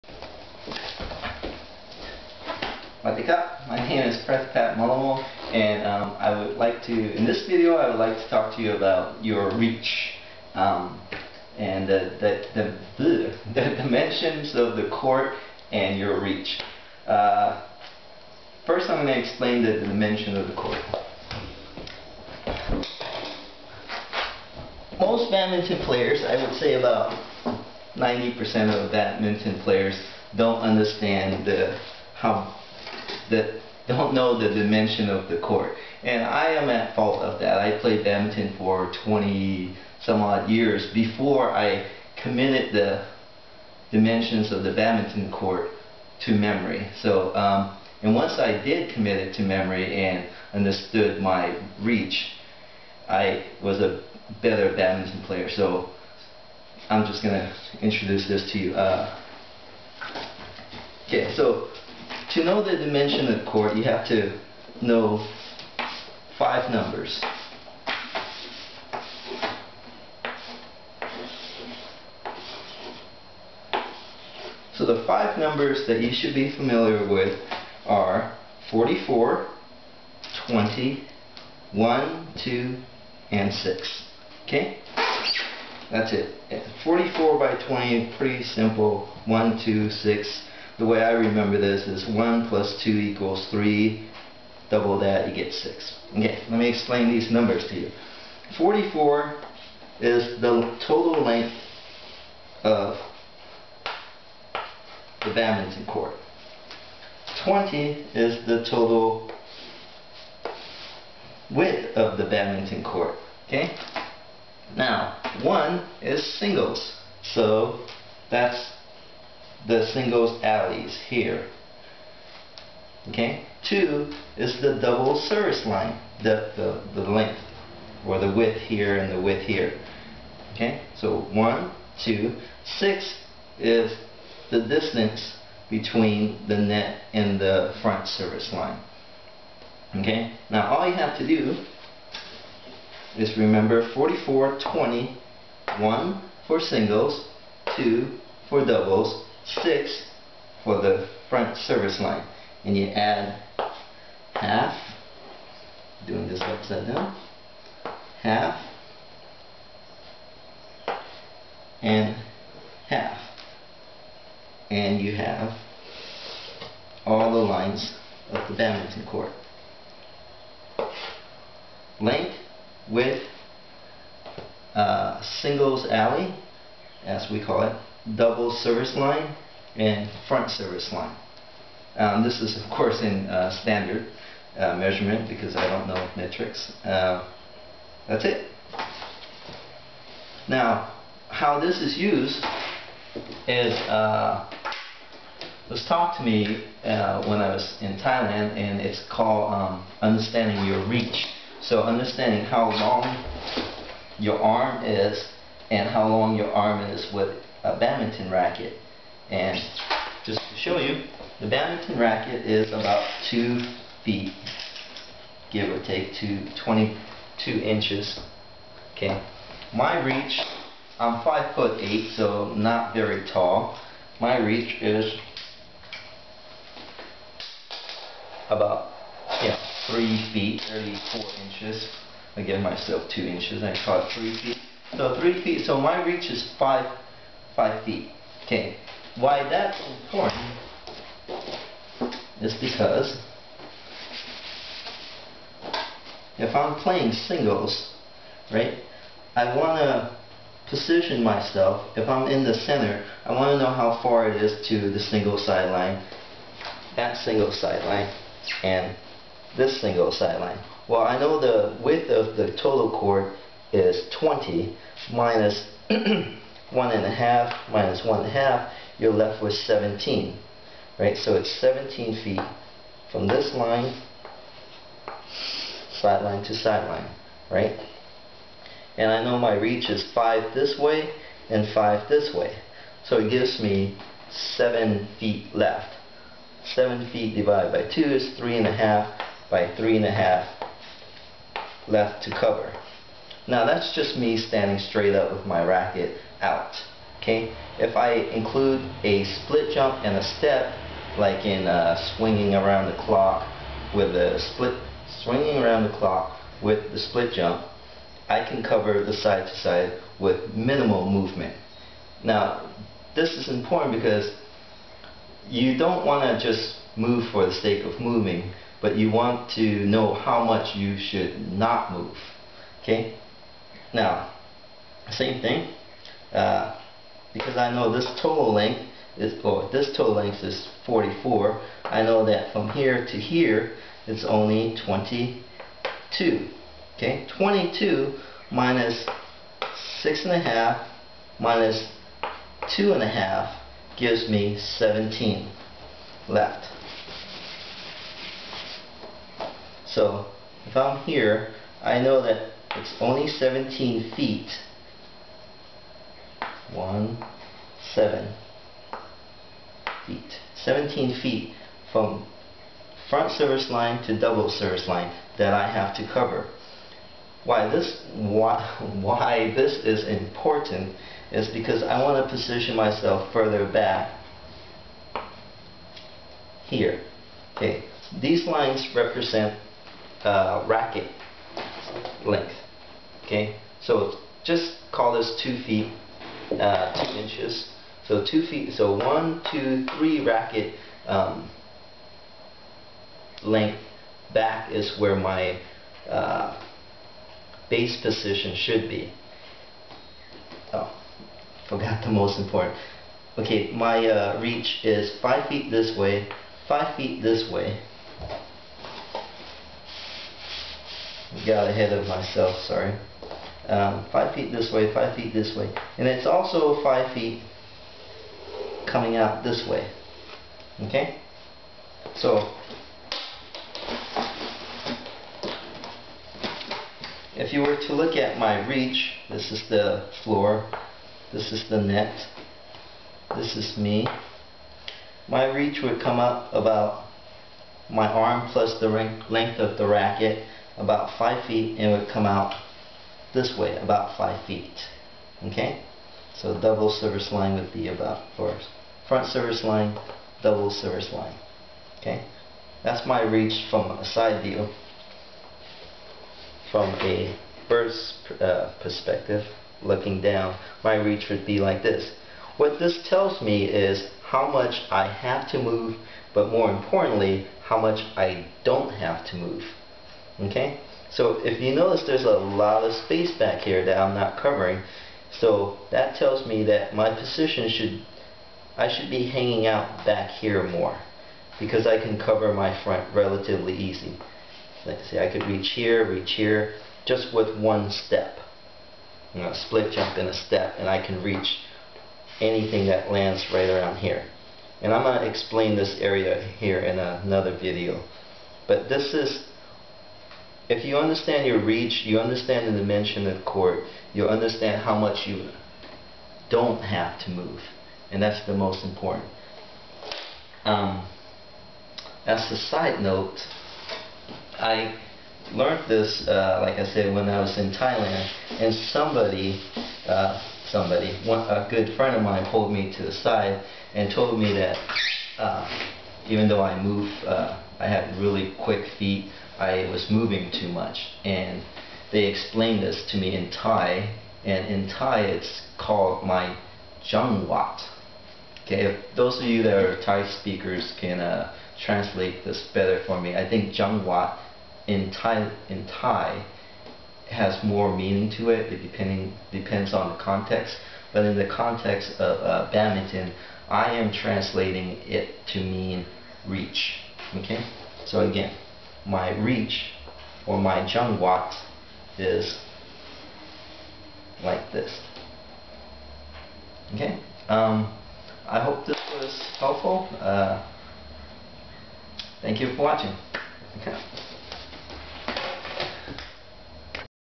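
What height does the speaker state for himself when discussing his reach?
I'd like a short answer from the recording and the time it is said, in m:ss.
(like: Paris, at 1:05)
5 foot 8, at 3:41.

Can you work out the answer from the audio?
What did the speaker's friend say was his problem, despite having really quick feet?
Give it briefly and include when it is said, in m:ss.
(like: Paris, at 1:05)
moving too much, at 8:50.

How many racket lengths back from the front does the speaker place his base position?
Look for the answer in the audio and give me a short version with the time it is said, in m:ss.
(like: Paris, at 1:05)
3, at 6:29.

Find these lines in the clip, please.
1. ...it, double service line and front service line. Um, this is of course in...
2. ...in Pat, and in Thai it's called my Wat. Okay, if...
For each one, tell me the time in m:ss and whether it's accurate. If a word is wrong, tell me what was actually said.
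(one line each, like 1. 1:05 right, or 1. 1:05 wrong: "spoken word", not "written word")
1. 2:57 right
2. 8:53 wrong: "Thai", not "Pat".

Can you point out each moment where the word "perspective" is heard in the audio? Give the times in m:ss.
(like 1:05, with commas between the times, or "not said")
7:38.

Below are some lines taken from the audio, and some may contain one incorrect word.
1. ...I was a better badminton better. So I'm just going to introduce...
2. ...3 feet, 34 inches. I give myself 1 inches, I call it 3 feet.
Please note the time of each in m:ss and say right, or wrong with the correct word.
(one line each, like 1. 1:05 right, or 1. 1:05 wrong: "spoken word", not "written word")
1. 0:53 wrong: "player", not "better"
2. 3:49 wrong: "2", not "1".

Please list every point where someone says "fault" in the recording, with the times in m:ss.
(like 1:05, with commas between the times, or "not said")
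0:36.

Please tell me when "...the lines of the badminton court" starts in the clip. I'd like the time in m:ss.
2:47.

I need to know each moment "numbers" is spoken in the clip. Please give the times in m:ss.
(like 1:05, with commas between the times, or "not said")
1:06, 1:15, 1:37.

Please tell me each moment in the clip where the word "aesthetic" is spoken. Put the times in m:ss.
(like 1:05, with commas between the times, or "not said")
not said.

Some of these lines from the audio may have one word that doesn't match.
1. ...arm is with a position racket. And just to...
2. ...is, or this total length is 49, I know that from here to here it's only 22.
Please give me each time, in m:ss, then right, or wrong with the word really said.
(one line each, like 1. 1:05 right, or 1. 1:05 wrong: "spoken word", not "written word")
1. 3:26 wrong: "badminton", not "position"
2. 5:29 wrong: "44", not "49".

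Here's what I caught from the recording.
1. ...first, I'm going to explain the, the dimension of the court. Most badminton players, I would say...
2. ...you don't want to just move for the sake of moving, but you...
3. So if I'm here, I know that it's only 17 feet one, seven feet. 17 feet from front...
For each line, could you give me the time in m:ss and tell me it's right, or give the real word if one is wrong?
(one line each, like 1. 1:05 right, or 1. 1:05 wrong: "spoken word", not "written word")
1. 0:18 right
2. 5:15 right
3. 5:49 right.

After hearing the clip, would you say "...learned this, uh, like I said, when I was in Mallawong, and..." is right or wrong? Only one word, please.
wrong.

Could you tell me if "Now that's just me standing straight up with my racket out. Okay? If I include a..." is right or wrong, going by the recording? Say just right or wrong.
right.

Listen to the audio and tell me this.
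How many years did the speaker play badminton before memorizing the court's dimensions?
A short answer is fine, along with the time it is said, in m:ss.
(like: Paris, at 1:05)
20 some odd years, at 0:39.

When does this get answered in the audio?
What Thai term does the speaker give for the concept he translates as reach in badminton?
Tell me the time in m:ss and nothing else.
9:03.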